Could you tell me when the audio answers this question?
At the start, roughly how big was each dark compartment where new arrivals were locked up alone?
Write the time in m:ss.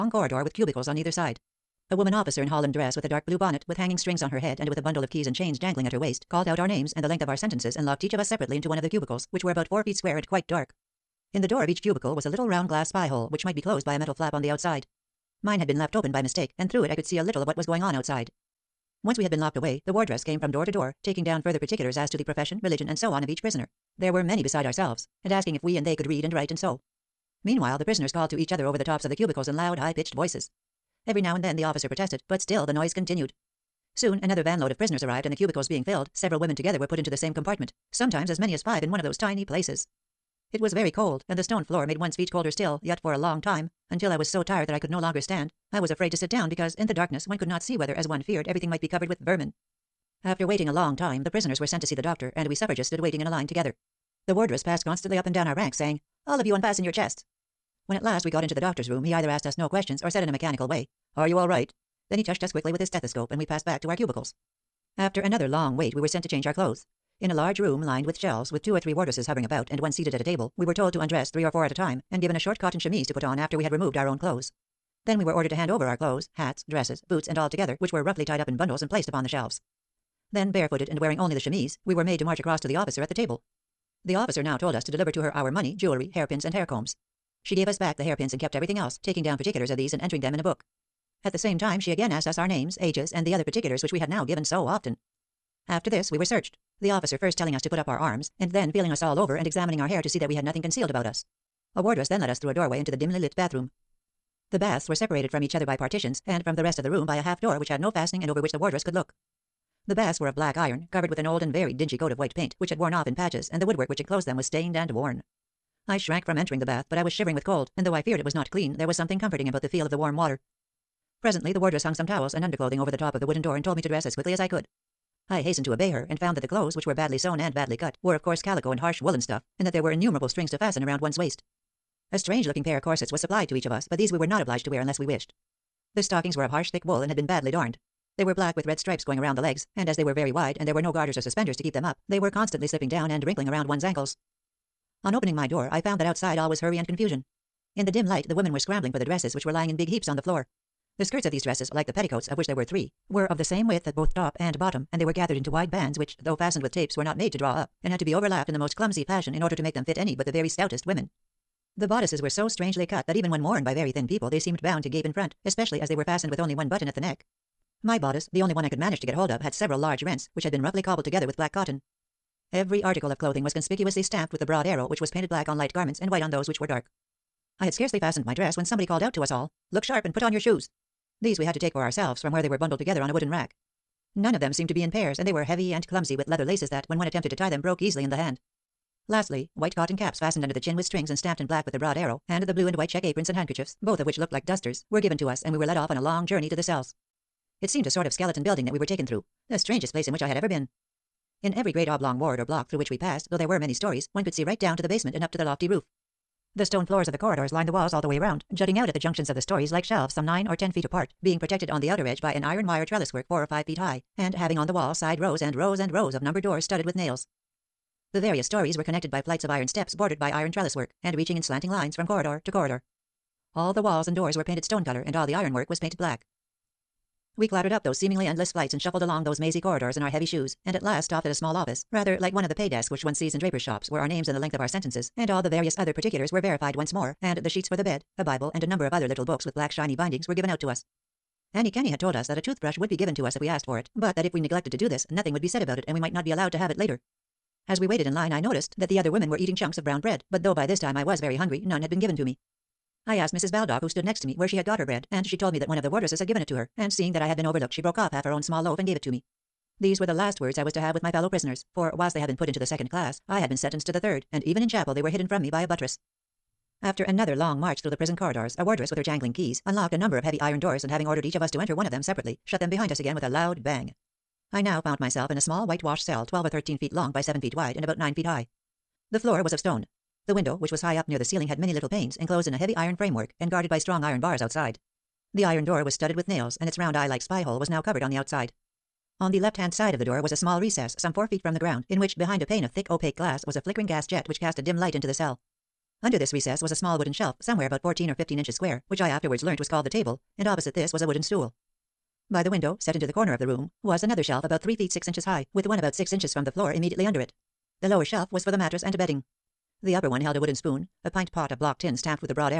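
0:09.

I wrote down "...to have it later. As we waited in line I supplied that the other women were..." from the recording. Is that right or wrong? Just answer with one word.
wrong.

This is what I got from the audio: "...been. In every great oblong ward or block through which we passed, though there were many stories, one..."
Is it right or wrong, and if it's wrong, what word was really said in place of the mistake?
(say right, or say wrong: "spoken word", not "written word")
right.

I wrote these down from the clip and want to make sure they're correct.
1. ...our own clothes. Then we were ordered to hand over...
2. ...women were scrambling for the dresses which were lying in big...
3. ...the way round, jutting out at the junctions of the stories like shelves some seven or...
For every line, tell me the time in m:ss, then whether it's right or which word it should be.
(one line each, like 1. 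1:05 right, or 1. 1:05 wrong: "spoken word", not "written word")
1. 1:13 right
2. 2:28 right
3. 3:28 wrong: "nine", not "seven".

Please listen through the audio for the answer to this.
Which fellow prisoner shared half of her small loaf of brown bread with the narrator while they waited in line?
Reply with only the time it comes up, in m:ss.
4:13.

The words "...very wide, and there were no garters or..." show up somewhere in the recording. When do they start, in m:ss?
2:20.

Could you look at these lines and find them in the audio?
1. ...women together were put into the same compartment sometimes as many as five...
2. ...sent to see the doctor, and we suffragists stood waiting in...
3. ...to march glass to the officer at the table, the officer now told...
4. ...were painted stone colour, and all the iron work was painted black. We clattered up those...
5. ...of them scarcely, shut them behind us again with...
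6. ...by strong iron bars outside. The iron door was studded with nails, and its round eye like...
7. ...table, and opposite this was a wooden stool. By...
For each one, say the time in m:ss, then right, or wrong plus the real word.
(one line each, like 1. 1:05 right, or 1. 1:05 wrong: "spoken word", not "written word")
1. 0:36 right
2. 0:51 right
3. 1:22 wrong: "across", not "glass"
4. 3:44 right
5. 4:31 wrong: "separately", not "scarcely"
6. 4:43 right
7. 4:59 right.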